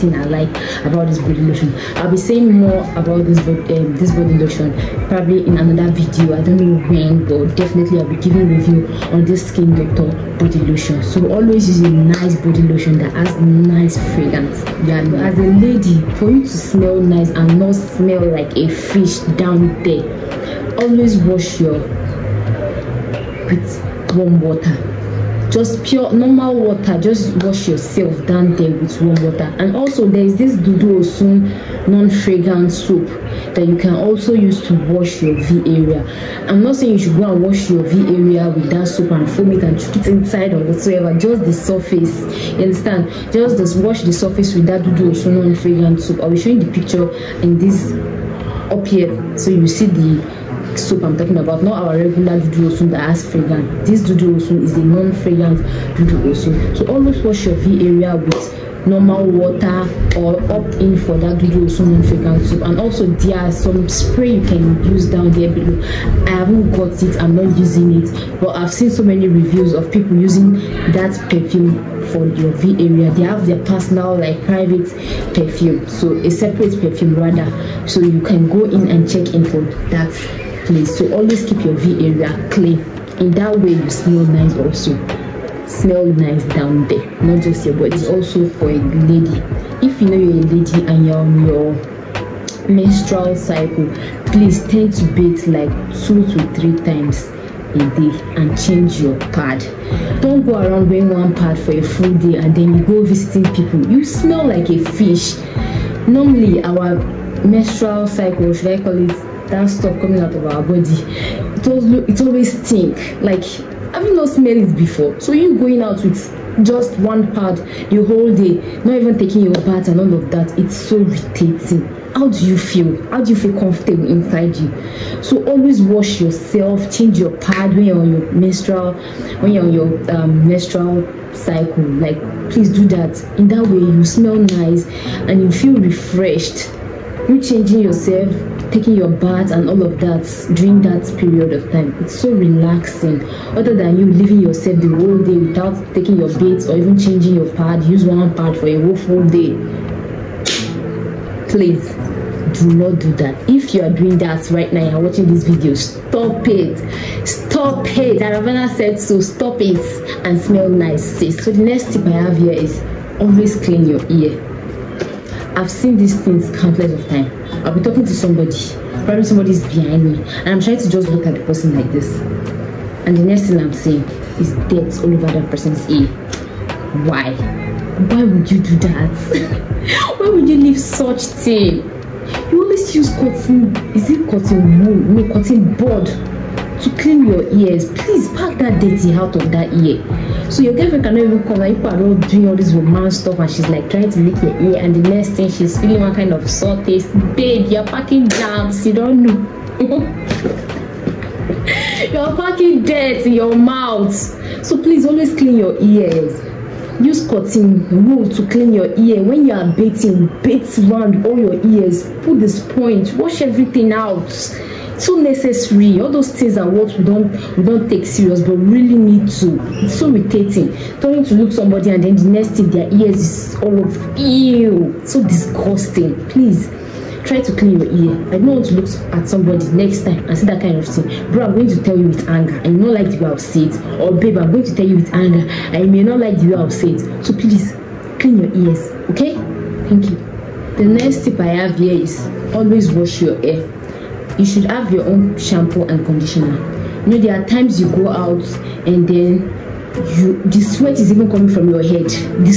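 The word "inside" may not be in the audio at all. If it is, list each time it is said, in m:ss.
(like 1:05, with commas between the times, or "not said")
0:40, 2:04.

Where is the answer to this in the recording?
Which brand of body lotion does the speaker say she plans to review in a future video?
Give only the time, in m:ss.
0:09.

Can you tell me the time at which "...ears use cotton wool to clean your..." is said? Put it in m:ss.
3:25.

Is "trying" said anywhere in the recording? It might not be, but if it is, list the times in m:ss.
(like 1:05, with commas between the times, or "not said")
2:50, 3:13.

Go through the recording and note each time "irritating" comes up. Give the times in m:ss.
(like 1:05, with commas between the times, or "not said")
2:00, 3:40.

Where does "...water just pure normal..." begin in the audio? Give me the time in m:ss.
0:24.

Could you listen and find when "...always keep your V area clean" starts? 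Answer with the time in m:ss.
1:21.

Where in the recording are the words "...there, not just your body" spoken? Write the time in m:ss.
1:26.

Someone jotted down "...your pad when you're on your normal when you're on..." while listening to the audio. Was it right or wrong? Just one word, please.
wrong.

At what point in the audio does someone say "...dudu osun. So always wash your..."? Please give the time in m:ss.
0:55.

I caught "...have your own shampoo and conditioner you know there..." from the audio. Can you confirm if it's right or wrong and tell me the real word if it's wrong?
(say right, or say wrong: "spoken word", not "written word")
right.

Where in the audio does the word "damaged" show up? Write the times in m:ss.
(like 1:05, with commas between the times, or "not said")
not said.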